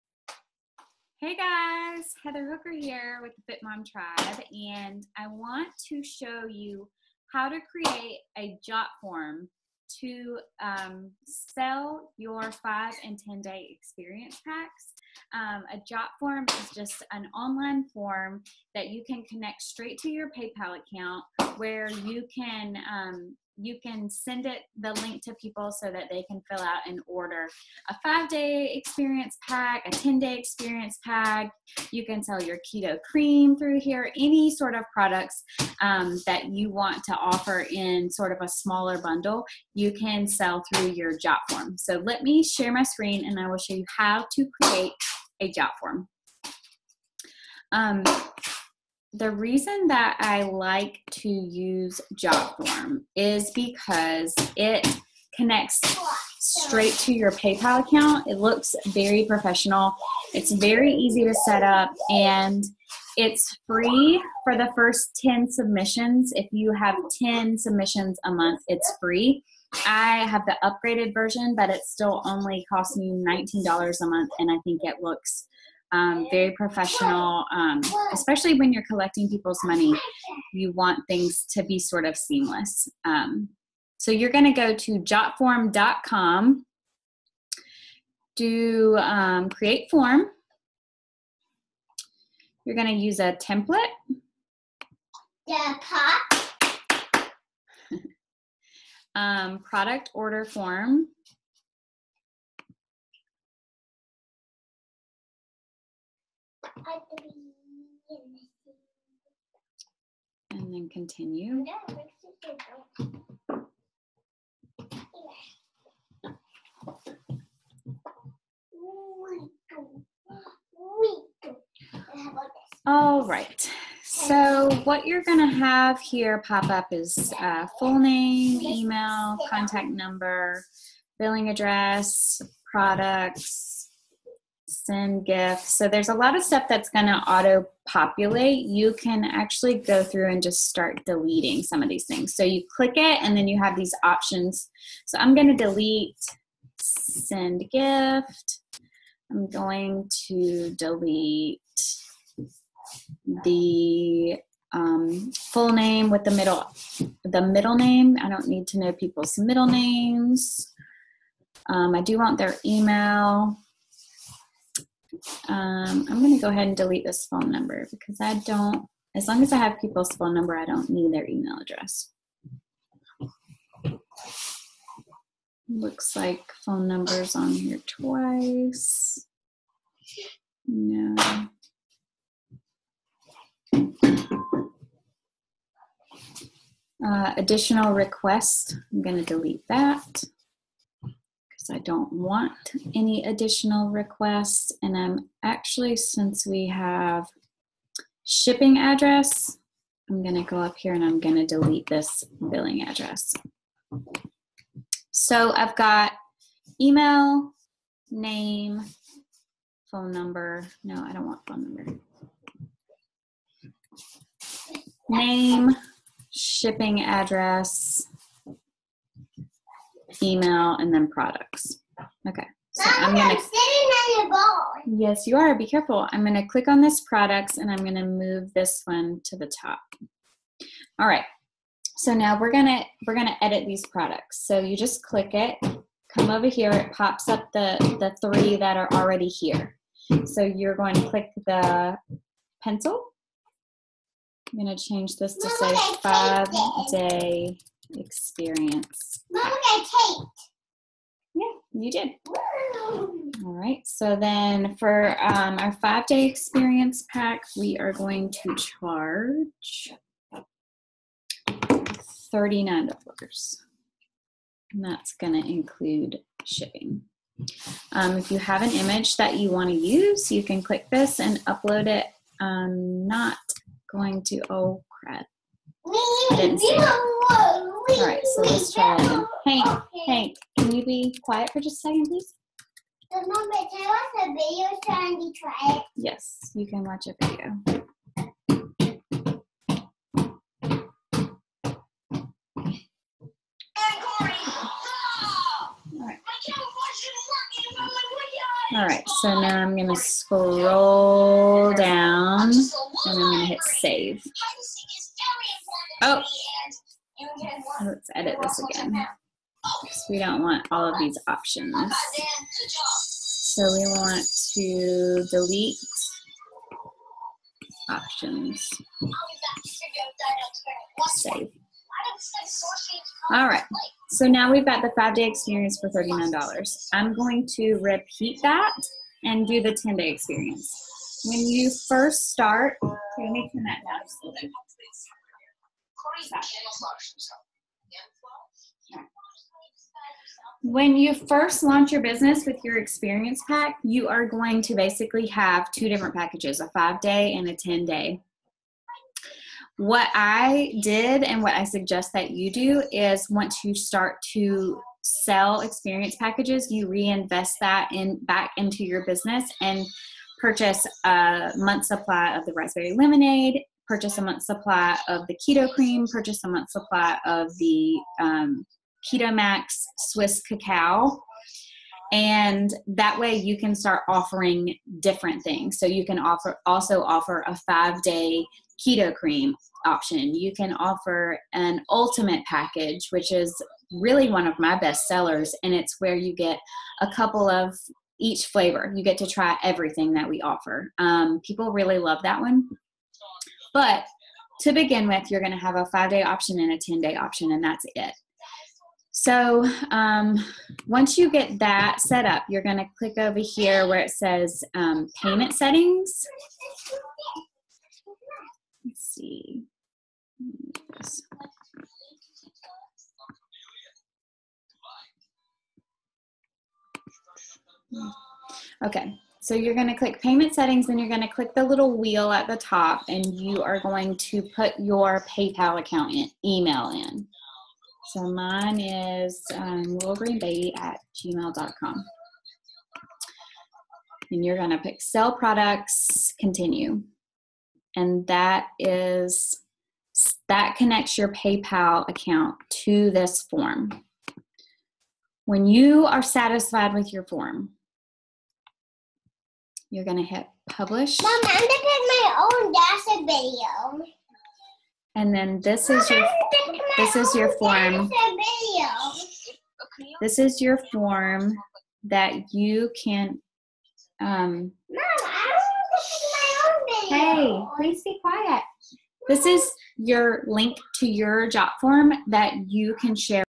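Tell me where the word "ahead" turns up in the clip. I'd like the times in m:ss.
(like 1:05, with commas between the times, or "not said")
2:46.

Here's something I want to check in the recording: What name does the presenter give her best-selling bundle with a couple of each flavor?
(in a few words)
ultimate package.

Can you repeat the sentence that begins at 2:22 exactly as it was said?
So you click it and then you have these options.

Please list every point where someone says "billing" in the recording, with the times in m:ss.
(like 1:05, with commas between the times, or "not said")
2:11, 3:22.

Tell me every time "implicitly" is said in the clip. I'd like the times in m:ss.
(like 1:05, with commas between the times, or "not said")
not said.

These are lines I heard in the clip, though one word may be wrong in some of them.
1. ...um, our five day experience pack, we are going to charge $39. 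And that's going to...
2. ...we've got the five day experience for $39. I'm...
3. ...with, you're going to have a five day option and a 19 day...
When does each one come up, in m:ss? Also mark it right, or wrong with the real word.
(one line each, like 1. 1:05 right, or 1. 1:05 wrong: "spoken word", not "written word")
1. 4:15 right
2. 5:24 right
3. 6:35 wrong: "10", not "19".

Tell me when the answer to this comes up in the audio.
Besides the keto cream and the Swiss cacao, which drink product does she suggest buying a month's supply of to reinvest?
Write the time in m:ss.
6:02.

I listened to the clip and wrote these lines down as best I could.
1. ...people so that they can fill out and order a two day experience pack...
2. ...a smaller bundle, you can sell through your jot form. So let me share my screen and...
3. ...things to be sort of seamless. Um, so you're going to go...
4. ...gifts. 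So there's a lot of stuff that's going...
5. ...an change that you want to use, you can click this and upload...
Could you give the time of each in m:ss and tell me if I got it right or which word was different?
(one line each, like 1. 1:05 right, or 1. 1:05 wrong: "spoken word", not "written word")
1. 0:25 wrong: "five", not "two"
2. 0:38 right
3. 1:21 right
4. 2:15 right
5. 4:28 wrong: "image", not "change".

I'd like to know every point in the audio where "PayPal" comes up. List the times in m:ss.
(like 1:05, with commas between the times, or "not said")
0:20, 0:57, 7:05, 7:21.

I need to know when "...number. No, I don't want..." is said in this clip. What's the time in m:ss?
3:30.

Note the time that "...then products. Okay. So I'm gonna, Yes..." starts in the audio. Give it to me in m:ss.
3:40.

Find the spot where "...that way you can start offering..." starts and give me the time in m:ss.
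6:12.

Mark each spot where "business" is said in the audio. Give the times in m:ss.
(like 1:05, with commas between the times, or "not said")
5:42, 5:59.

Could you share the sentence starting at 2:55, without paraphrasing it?
Looks like phone numbers on here twice.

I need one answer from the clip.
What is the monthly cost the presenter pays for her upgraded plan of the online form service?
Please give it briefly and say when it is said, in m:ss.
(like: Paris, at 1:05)
$19, at 1:13.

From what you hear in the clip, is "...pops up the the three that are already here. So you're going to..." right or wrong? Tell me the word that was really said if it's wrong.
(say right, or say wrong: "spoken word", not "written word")
right.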